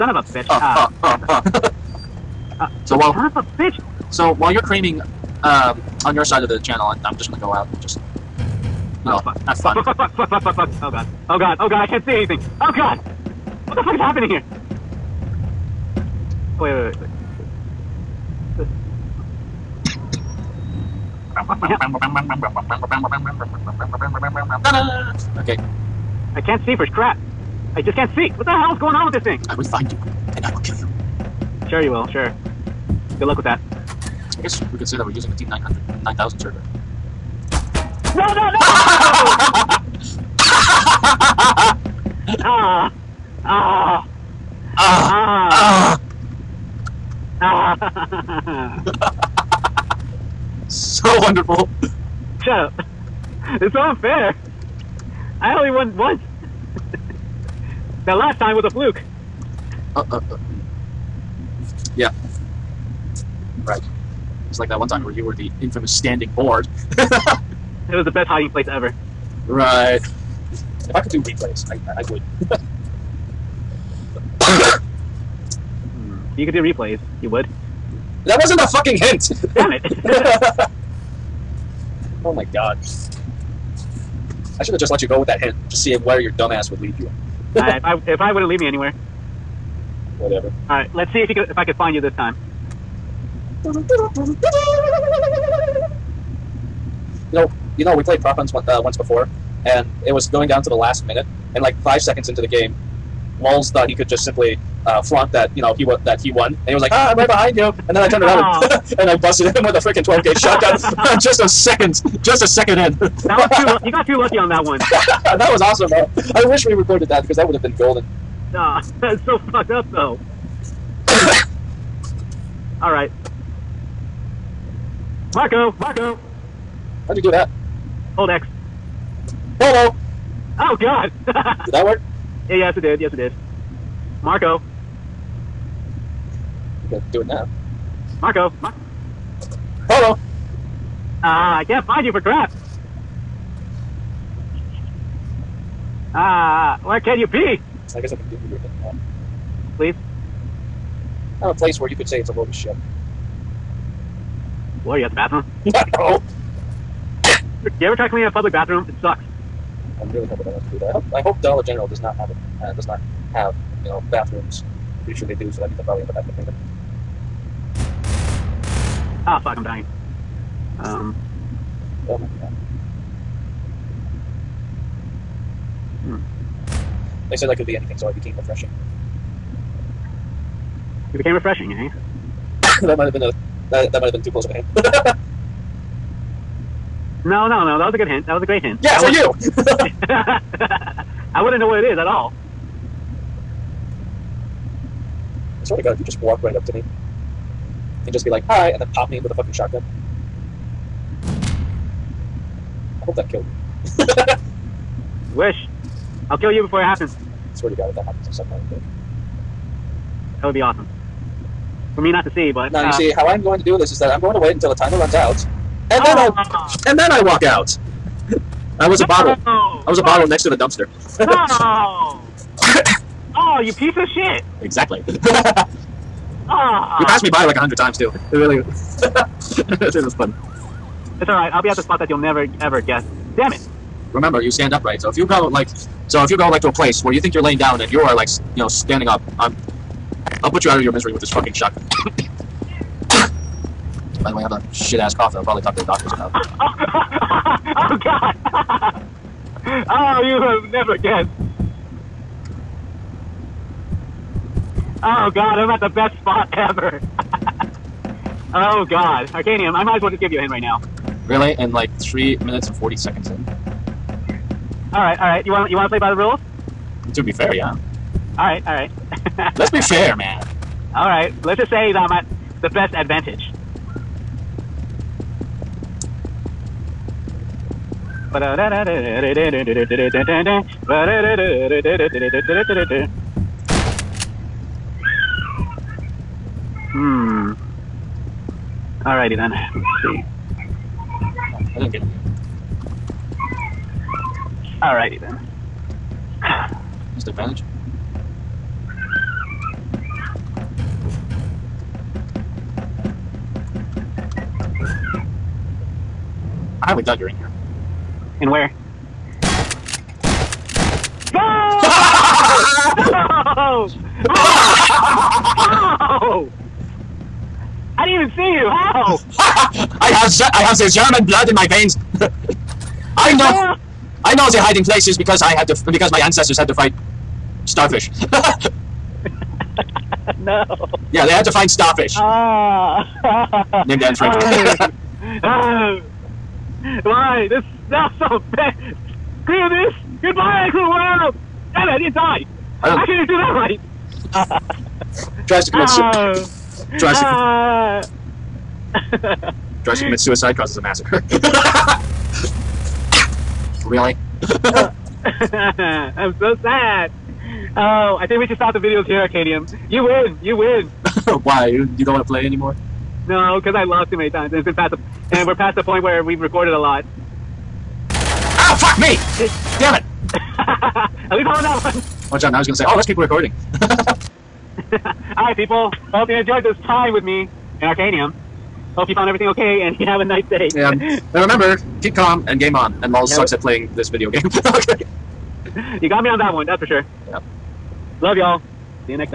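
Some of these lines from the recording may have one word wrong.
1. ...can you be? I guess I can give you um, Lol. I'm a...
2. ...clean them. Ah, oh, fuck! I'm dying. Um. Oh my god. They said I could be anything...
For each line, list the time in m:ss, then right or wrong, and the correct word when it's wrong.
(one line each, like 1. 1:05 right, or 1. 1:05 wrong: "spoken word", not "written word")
1. 2:26 wrong: "Please", not "Lol"
2. 2:46 right.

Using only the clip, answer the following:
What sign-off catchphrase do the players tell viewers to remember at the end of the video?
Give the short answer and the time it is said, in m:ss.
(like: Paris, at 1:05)
Keep calm and game on, at 6:22.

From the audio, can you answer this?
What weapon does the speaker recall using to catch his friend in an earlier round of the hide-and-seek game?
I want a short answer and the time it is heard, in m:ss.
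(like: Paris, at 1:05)
12 gauge shotgun, at 1:50.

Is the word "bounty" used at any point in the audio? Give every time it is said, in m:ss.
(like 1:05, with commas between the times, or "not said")
not said.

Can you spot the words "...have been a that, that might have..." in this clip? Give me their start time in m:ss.
3:03.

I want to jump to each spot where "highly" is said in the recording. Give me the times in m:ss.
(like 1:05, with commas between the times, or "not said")
5:06.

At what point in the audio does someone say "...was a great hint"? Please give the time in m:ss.
3:08.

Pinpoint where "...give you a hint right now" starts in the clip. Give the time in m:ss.
4:20.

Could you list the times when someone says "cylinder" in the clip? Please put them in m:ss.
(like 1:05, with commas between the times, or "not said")
not said.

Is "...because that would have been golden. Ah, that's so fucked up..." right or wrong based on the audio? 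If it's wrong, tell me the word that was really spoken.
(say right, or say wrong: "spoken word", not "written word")
right.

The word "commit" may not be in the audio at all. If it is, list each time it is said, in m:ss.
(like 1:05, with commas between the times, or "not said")
5:45, 5:50.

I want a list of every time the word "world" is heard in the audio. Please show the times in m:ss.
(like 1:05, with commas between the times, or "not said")
5:40.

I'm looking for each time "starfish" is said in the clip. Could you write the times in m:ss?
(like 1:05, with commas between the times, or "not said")
5:27, 5:31.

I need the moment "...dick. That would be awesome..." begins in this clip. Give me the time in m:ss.
3:28.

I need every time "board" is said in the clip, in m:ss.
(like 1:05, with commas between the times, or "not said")
1:06.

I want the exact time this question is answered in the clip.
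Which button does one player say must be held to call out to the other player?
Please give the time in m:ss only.
2:08.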